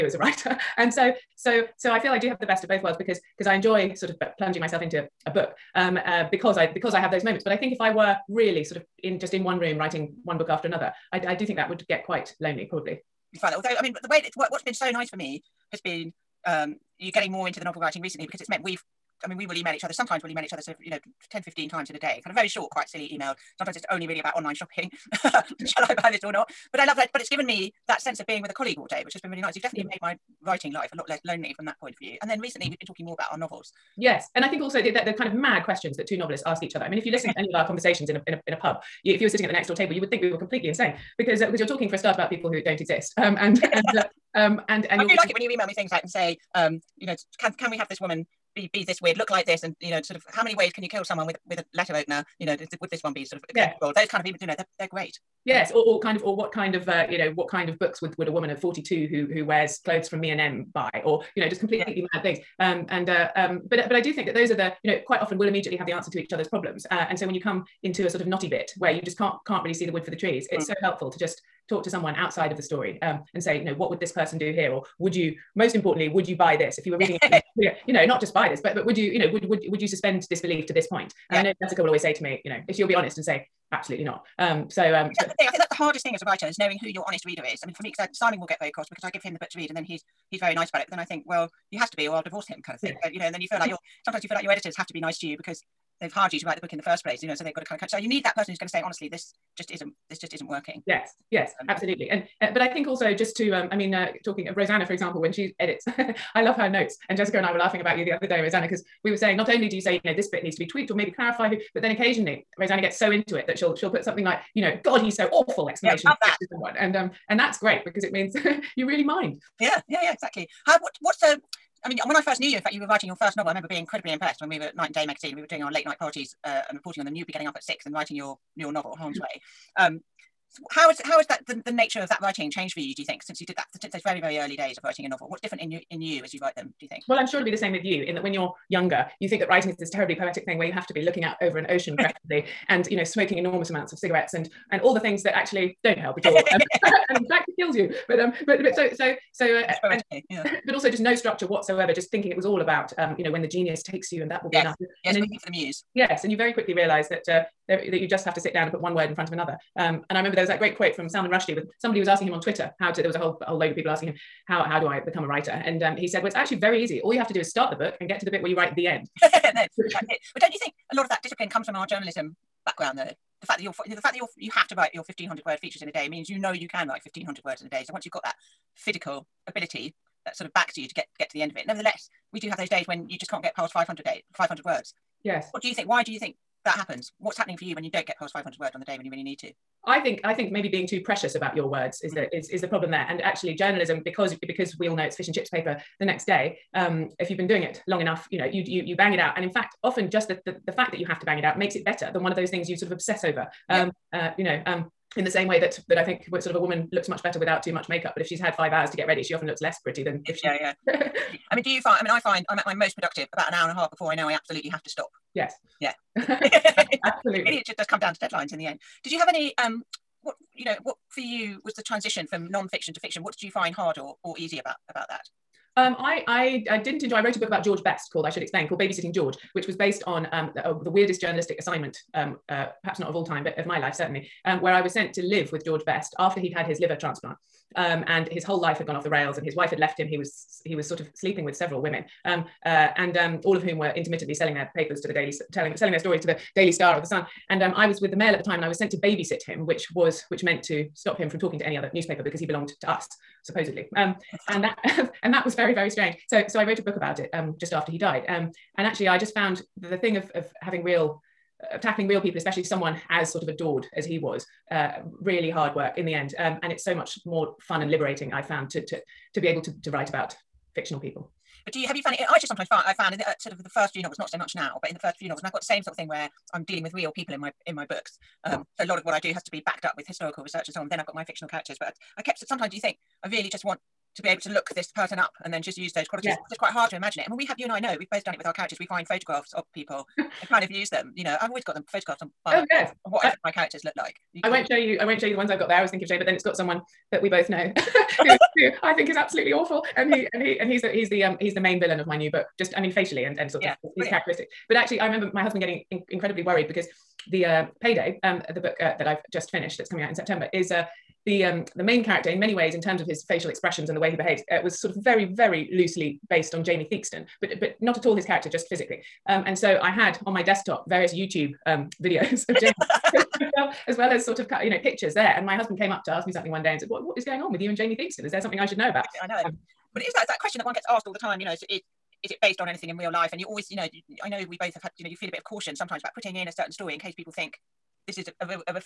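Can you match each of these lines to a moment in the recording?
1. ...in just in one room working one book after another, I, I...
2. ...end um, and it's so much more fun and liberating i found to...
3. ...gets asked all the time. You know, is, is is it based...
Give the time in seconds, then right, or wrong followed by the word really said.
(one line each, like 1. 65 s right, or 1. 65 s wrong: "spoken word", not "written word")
1. 9 s wrong: "writing", not "working"
2. 266 s right
3. 330 s right.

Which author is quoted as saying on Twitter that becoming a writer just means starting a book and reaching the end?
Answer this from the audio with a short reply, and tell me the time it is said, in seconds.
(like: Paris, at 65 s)
Salman Rushdie, at 161 s.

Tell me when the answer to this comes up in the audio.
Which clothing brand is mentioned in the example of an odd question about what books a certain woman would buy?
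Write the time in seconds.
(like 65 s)
60 s.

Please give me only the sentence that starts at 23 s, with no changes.
Sometimes it's only really about online shopping.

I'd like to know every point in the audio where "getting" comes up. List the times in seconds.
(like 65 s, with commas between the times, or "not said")
17 s, 127 s, 305 s.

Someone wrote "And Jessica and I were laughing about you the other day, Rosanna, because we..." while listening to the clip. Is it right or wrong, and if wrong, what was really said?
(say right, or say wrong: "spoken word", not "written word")
right.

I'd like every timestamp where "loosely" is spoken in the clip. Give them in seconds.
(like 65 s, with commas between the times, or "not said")
315 s.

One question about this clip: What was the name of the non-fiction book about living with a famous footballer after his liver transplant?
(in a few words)
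Babysitting George.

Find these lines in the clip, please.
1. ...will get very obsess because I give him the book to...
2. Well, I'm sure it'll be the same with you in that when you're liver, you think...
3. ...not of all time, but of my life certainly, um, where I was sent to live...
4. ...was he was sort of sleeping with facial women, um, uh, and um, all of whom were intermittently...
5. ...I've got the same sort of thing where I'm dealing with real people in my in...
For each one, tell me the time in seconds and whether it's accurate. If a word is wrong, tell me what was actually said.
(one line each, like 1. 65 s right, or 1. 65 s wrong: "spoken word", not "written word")
1. 88 s wrong: "cross", not "obsess"
2. 137 s wrong: "younger", not "liver"
3. 232 s right
4. 240 s wrong: "several", not "facial"
5. 275 s right.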